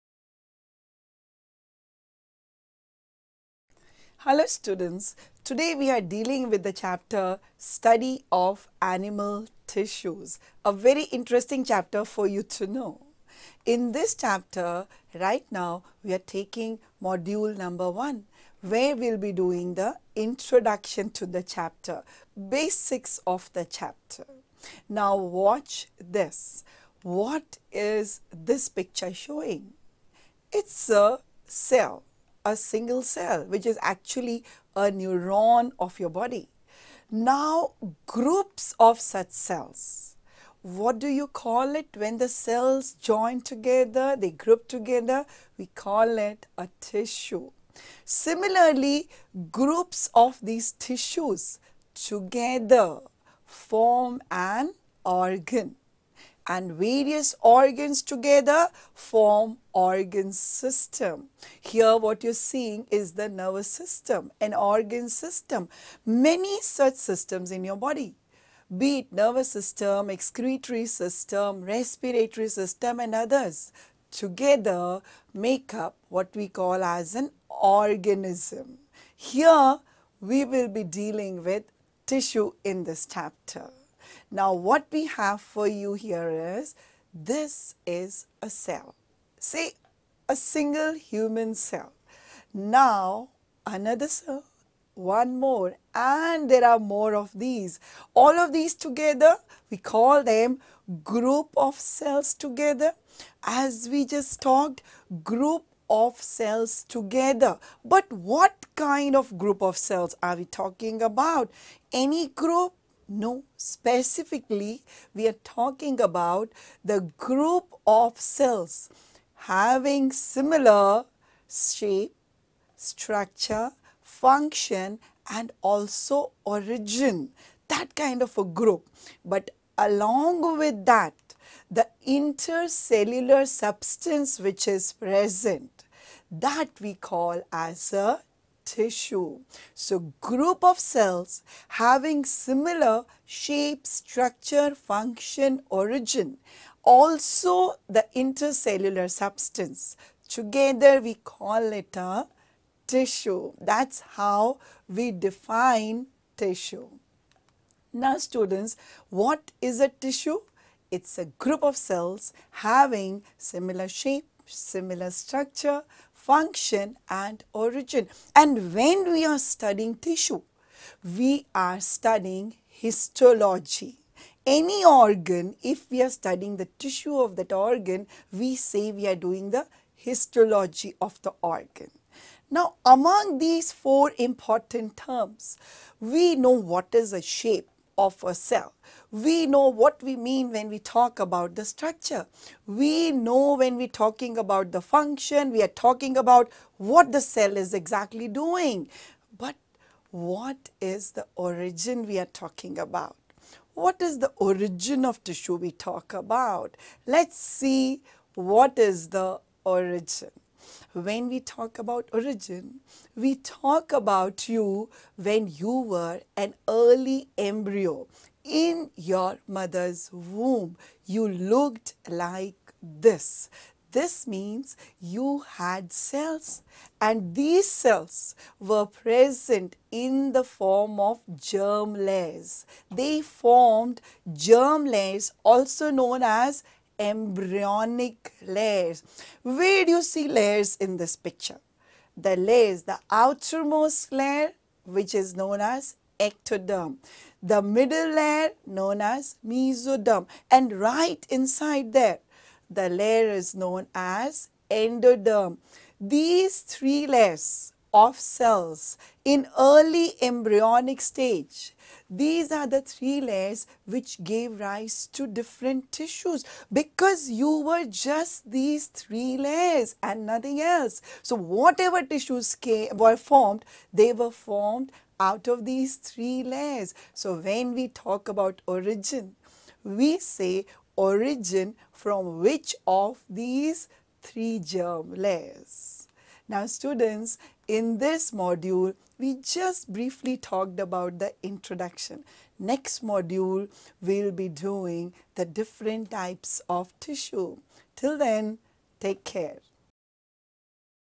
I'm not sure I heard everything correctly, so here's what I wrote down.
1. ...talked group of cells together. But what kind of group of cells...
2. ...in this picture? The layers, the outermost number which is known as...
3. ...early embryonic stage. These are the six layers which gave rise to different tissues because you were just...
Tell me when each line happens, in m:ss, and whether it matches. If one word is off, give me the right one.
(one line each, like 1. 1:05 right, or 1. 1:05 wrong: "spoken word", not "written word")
1. 1:44 right
2. 4:00 wrong: "layer", not "number"
3. 4:19 wrong: "three", not "six".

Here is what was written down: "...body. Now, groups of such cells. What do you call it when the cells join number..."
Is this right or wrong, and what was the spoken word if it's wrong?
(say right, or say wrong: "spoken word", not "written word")
wrong: "together", not "number".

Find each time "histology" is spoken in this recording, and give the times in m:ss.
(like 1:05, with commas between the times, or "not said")
2:52, 2:59.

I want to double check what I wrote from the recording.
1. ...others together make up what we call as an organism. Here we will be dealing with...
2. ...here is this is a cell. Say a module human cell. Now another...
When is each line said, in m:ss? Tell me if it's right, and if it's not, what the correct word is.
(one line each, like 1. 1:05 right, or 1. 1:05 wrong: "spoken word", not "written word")
1. 1:13 right
2. 1:25 wrong: "single", not "module".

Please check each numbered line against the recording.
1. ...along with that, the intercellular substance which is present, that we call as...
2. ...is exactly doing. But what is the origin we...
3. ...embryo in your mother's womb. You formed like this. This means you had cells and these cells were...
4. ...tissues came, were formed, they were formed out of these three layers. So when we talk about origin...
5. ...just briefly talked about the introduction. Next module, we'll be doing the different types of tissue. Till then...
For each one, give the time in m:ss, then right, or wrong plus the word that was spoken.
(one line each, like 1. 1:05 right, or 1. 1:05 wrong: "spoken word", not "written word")
1. 2:09 right
2. 3:17 right
3. 3:37 wrong: "looked", not "formed"
4. 4:32 right
5. 4:49 right.